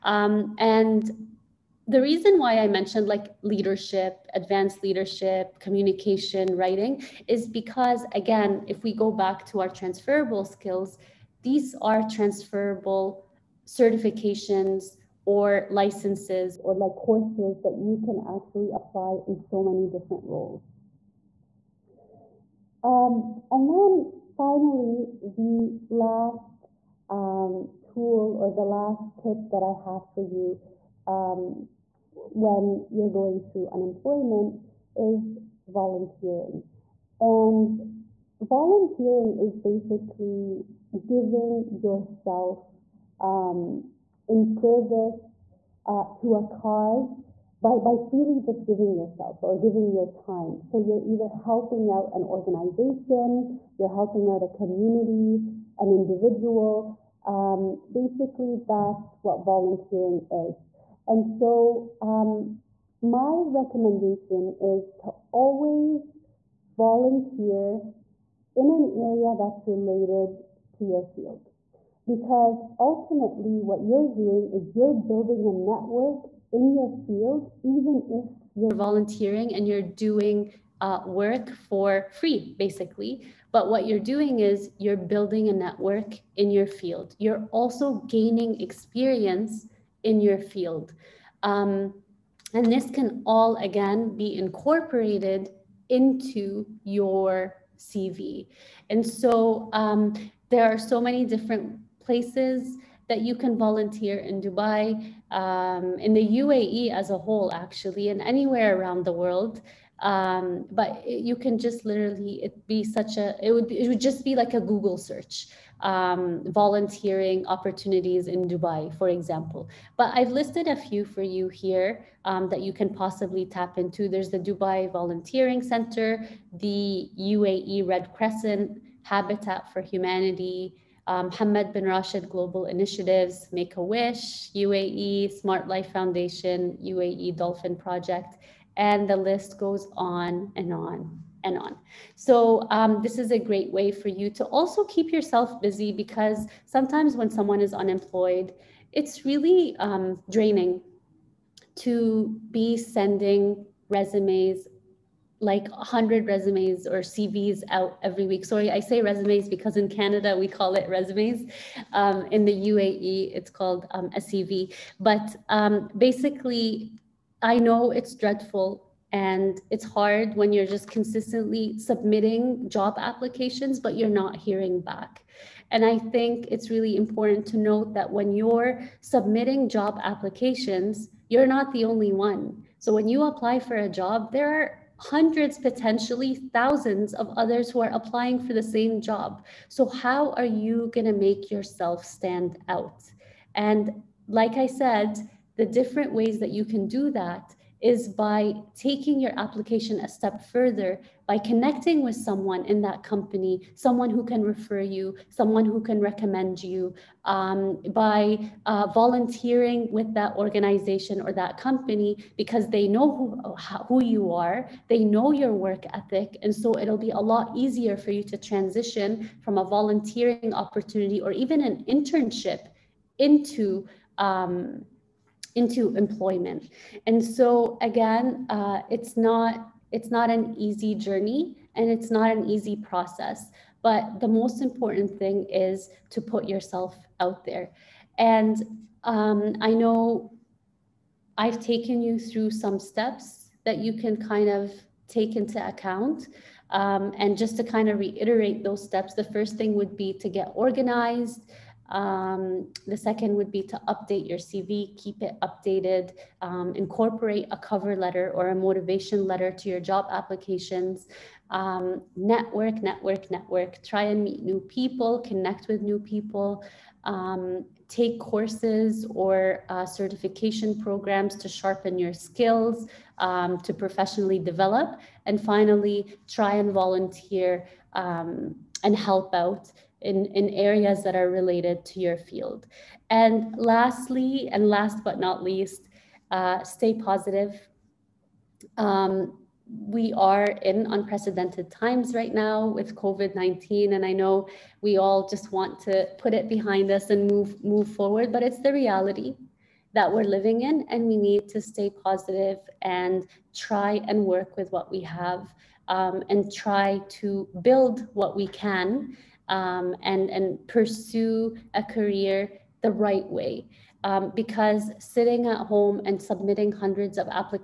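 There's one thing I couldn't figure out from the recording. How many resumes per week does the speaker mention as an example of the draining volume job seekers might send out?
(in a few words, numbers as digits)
100.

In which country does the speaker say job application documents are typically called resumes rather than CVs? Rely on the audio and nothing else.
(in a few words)
Canada.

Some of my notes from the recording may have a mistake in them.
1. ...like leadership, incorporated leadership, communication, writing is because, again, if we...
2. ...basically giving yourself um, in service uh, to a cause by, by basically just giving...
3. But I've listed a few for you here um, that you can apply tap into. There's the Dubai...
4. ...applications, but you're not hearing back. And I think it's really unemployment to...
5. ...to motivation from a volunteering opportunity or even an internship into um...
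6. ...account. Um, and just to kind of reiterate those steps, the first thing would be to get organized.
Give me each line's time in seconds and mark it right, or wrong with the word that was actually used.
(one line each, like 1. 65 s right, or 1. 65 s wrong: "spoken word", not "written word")
1. 3 s wrong: "advanced", not "incorporated"
2. 39 s wrong: "freely", not "basically"
3. 119 s wrong: "possibly", not "apply"
4. 172 s wrong: "important", not "unemployment"
5. 218 s wrong: "transition", not "motivation"
6. 245 s right.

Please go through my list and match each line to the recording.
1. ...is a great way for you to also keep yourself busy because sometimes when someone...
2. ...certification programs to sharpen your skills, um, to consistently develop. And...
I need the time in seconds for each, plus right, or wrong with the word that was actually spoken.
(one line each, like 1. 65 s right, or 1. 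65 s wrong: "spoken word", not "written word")
1. 143 s right
2. 269 s wrong: "professionally", not "consistently".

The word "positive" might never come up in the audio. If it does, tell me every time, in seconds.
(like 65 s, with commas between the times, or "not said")
286 s, 301 s.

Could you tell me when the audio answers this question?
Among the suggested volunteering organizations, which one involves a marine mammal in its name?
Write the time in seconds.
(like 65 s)
136 s.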